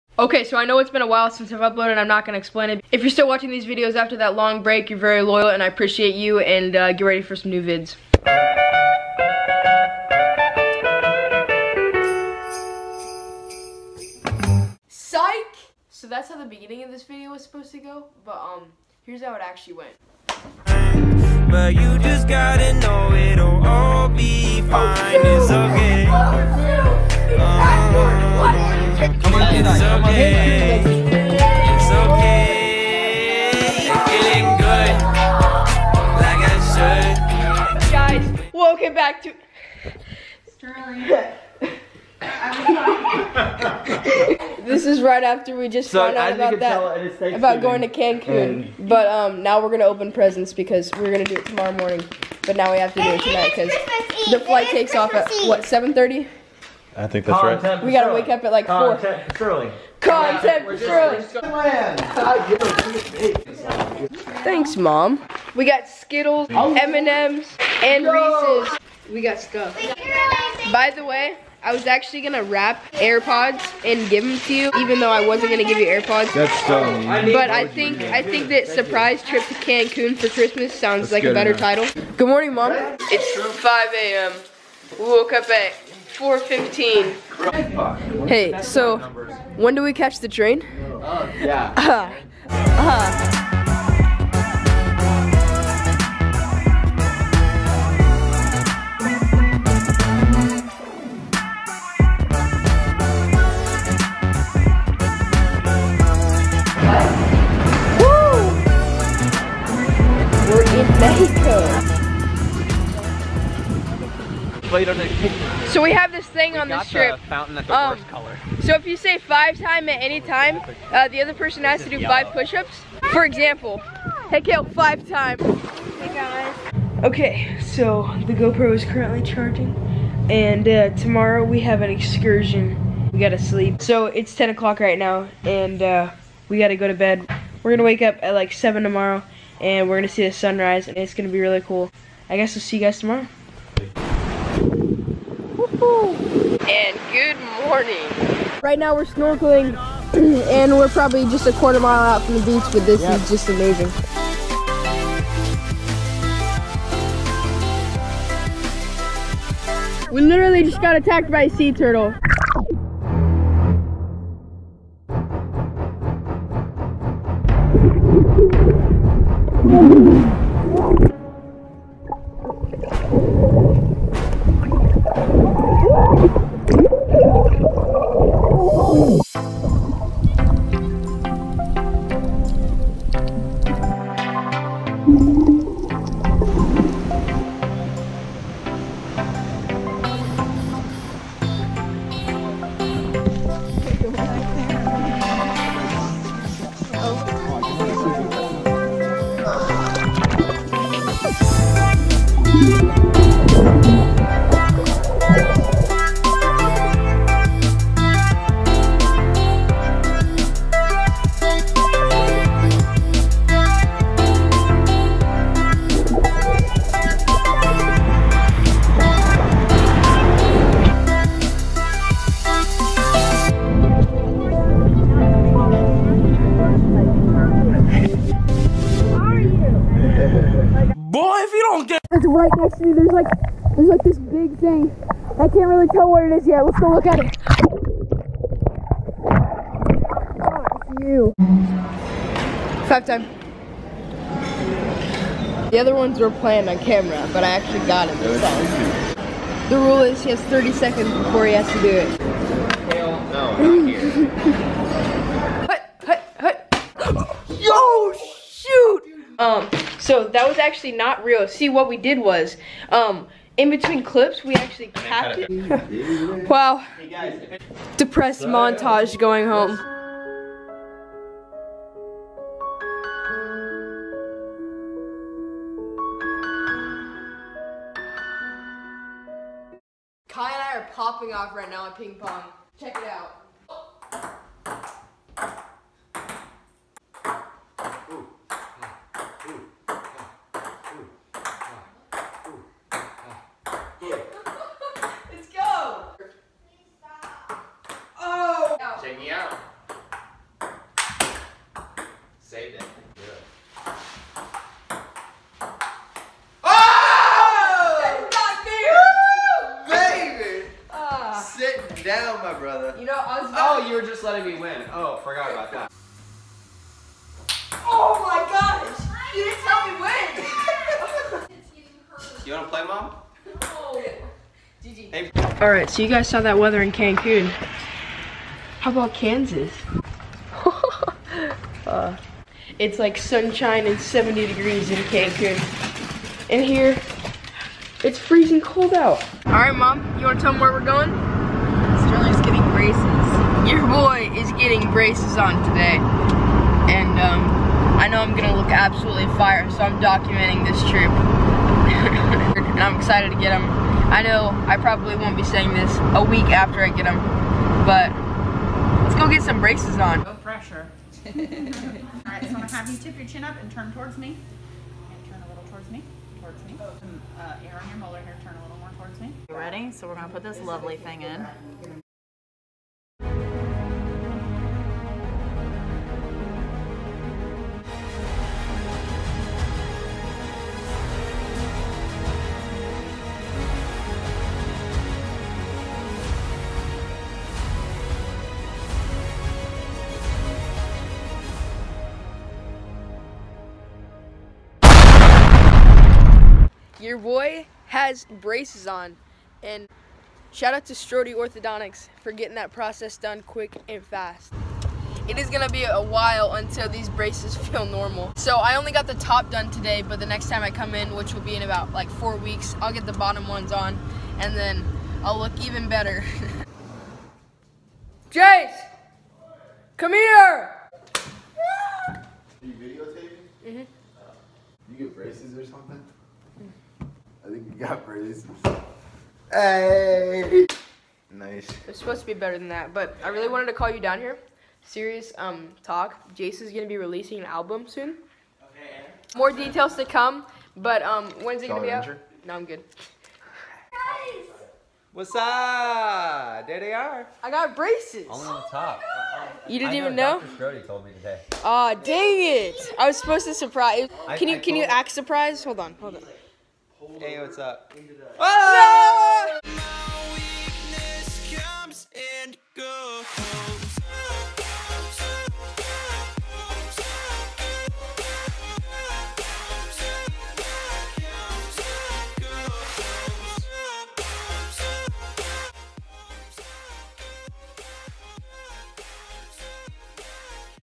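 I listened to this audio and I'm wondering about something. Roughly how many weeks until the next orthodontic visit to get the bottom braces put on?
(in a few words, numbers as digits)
4 weeks.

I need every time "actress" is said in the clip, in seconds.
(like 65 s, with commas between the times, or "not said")
not said.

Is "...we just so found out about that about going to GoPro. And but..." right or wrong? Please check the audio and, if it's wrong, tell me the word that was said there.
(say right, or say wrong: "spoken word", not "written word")
wrong: "Cancun", not "GoPro".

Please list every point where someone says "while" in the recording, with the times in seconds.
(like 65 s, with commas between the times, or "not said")
1 s, 405 s.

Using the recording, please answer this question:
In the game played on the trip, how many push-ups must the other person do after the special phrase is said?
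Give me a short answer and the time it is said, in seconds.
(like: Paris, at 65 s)
5, at 122 s.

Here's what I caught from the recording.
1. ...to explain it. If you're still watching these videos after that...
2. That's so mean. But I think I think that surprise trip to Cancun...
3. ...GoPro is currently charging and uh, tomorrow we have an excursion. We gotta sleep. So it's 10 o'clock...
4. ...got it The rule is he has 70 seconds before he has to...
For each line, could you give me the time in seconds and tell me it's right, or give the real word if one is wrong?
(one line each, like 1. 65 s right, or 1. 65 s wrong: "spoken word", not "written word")
1. 2 s right
2. 76 s right
3. 128 s right
4. 247 s wrong: "30", not "70".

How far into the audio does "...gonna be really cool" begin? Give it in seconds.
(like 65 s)
141 s.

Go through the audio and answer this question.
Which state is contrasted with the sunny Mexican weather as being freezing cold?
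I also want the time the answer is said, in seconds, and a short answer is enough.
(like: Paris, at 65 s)
Kansas, at 329 s.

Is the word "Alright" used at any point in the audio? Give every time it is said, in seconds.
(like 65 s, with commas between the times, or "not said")
325 s, 339 s.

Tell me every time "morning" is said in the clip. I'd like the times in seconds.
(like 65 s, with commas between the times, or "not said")
51 s, 82 s, 147 s.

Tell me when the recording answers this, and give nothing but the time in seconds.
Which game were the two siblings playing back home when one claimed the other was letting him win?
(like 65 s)
281 s.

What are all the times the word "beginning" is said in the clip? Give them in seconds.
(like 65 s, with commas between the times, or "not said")
16 s.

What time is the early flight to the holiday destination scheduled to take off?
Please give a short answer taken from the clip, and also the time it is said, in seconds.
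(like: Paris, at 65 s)
7:30, at 55 s.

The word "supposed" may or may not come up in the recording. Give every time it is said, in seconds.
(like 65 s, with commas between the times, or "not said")
17 s, 431 s, 453 s.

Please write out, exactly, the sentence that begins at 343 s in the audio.
your boy is getting braces on today.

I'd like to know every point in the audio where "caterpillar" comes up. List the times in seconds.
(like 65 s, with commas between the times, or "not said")
not said.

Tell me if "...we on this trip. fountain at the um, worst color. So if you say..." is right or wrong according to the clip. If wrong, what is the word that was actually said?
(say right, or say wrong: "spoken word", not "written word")
right.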